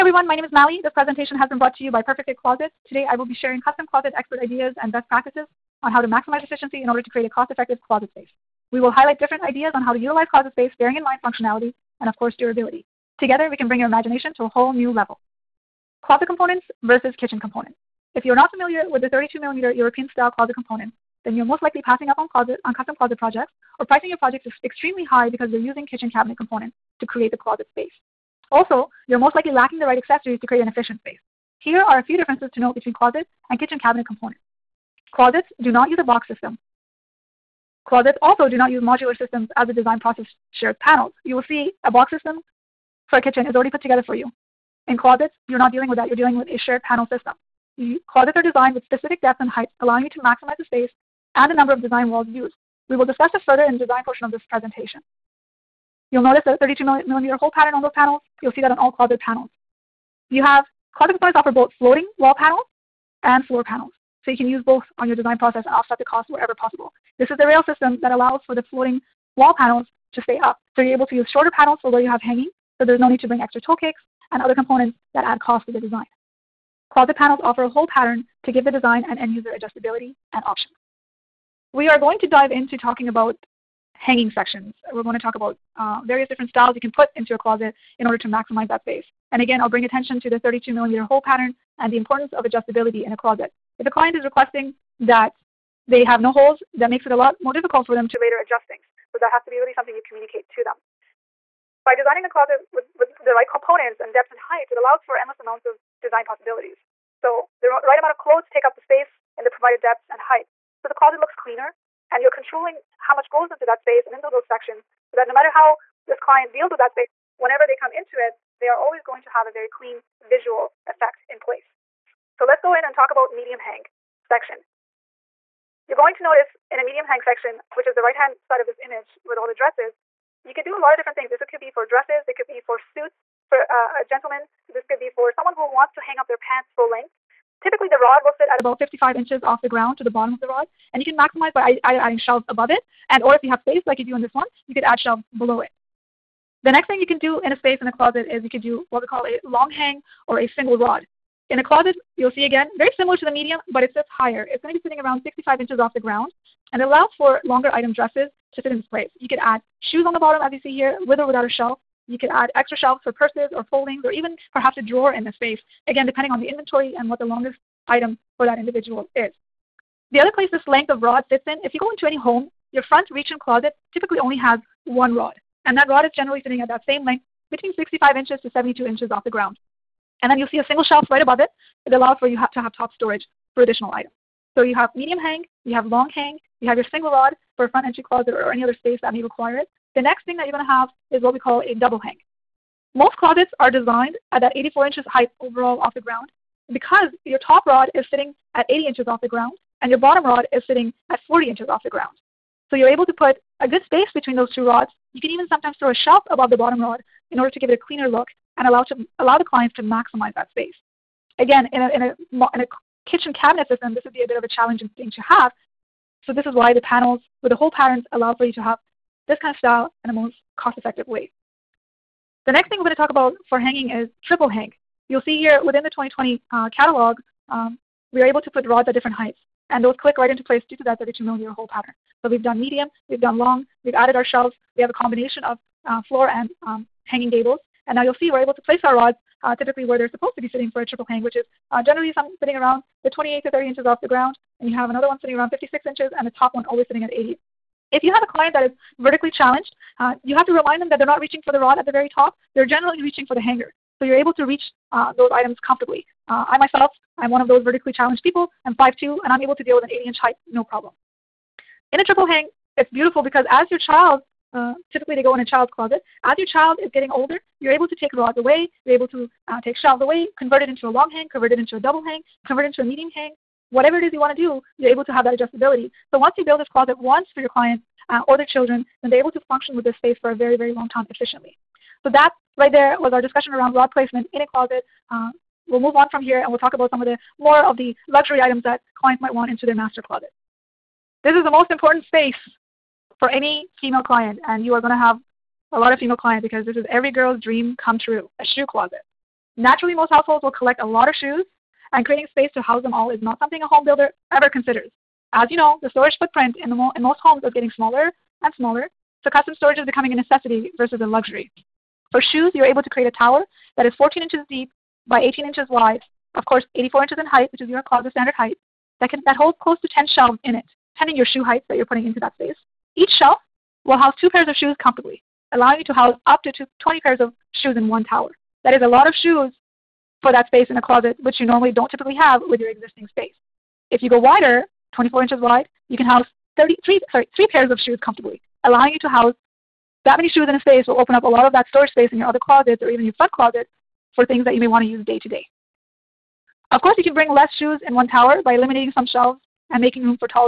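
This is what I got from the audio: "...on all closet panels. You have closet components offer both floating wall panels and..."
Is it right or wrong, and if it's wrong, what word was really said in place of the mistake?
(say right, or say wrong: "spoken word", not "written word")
right.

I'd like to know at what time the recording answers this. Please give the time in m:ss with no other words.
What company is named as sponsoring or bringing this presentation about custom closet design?
0:02.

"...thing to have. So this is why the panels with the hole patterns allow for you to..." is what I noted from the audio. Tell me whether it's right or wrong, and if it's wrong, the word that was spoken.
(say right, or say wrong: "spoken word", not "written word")
right.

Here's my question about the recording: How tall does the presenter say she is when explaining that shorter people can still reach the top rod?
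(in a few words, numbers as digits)
5'2".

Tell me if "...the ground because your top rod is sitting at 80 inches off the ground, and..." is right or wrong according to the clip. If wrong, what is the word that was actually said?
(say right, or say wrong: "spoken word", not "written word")
right.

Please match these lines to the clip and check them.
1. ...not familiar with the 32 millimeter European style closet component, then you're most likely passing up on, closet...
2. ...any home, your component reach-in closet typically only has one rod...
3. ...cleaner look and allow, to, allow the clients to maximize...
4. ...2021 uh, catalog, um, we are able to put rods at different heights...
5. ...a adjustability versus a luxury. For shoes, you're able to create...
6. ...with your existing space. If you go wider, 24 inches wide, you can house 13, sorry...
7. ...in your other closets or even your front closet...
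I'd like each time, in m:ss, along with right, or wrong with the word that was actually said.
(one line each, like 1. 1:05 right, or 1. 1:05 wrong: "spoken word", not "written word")
1. 0:18 right
2. 2:52 wrong: "front", not "component"
3. 3:27 right
4. 3:45 wrong: "2020", not "2021"
5. 5:10 wrong: "necessity", not "adjustability"
6. 5:32 wrong: "33", not "13"
7. 5:42 right.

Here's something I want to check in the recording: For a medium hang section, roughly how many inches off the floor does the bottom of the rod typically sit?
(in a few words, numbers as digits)
55 inches.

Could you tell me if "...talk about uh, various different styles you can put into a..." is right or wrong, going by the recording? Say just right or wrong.
right.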